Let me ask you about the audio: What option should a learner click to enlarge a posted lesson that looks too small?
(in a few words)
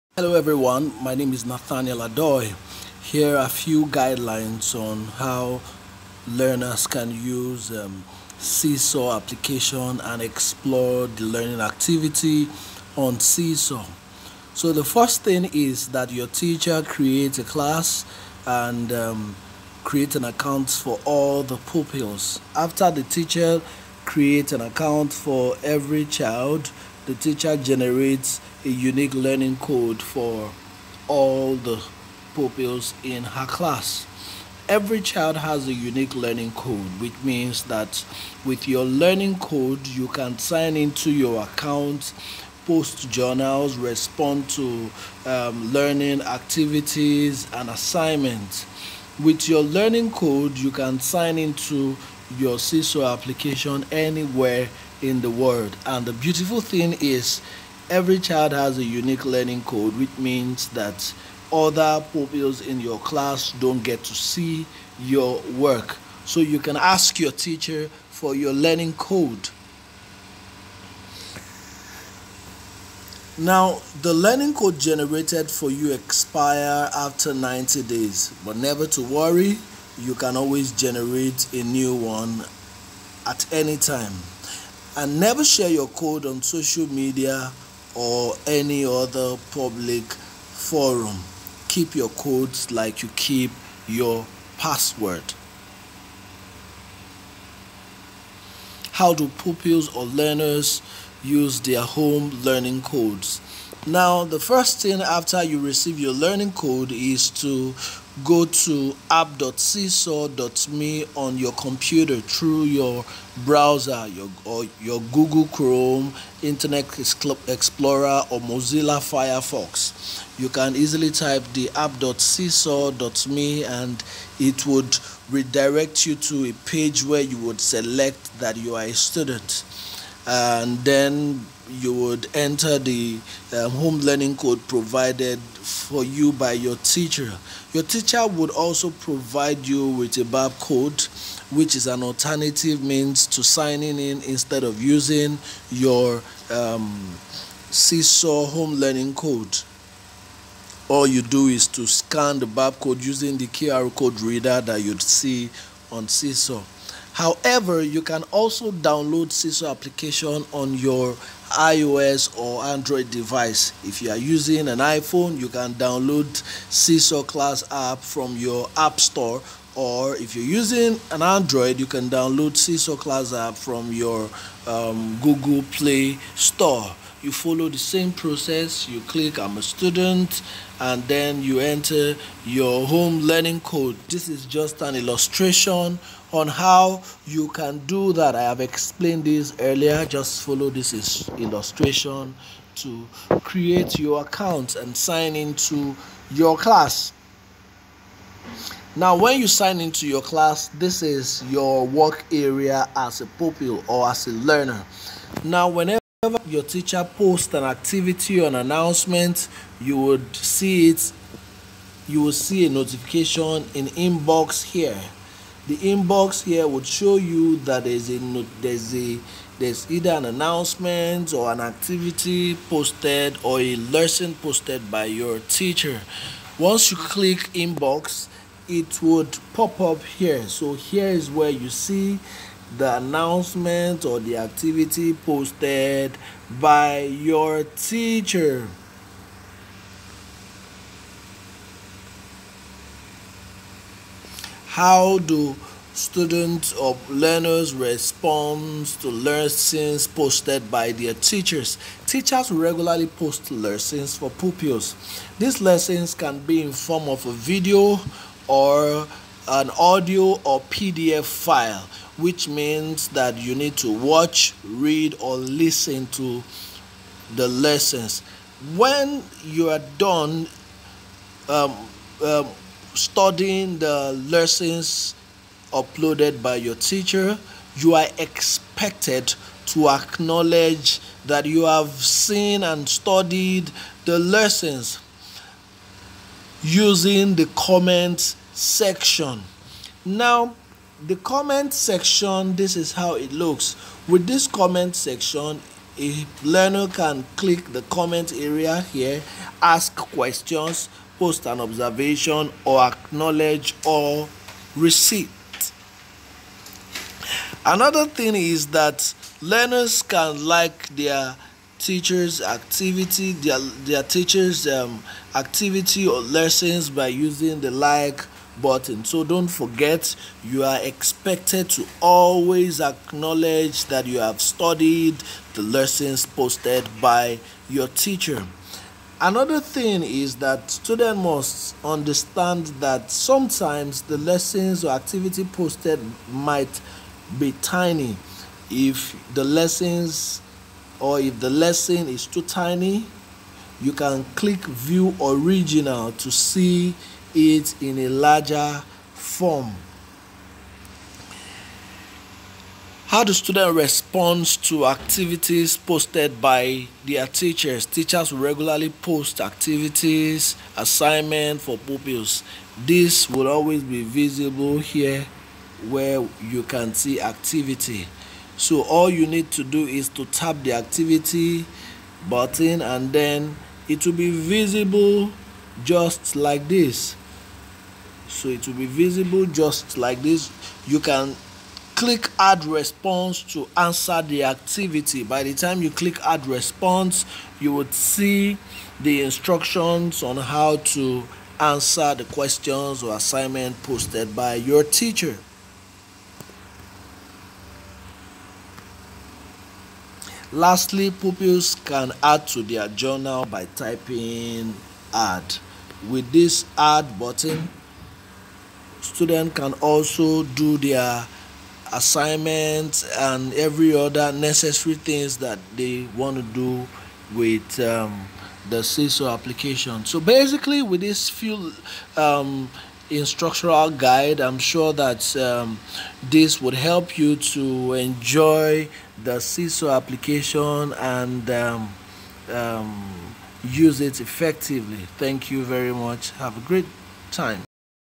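view original.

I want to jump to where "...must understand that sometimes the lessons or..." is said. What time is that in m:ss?
5:31.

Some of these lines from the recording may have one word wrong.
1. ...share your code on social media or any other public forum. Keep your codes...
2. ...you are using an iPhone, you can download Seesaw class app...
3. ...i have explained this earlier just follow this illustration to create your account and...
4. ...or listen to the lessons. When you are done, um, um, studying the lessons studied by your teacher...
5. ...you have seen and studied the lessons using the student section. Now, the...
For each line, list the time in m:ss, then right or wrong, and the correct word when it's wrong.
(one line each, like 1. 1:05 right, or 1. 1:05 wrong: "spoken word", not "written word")
1. 1:25 right
2. 2:44 right
3. 3:08 right
4. 4:25 wrong: "uploaded", not "studied"
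5. 4:41 wrong: "comment", not "student".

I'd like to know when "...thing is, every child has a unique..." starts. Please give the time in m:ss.
0:56.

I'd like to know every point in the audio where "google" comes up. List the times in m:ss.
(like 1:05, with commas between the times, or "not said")
1:55, 2:55.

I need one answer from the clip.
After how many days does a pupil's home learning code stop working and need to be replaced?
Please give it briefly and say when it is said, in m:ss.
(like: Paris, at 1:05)
90, at 1:17.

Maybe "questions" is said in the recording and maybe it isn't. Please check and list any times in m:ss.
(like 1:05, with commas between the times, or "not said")
4:59, 6:32.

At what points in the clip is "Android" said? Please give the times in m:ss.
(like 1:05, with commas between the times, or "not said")
2:42, 2:51.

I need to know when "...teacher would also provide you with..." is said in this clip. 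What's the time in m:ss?
2:17.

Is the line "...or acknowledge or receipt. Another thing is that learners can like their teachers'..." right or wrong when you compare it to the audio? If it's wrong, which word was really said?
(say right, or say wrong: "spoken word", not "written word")
right.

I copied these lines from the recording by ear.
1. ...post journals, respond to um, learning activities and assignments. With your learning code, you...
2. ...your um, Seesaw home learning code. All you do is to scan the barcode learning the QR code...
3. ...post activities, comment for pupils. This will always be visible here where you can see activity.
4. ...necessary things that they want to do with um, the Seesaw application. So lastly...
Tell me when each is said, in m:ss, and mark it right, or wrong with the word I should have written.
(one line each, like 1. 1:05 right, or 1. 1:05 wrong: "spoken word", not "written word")
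1. 0:42 right
2. 2:25 wrong: "using", not "learning"
3. 5:58 wrong: "assignment", not "comment"
4. 6:54 wrong: "basically", not "lastly".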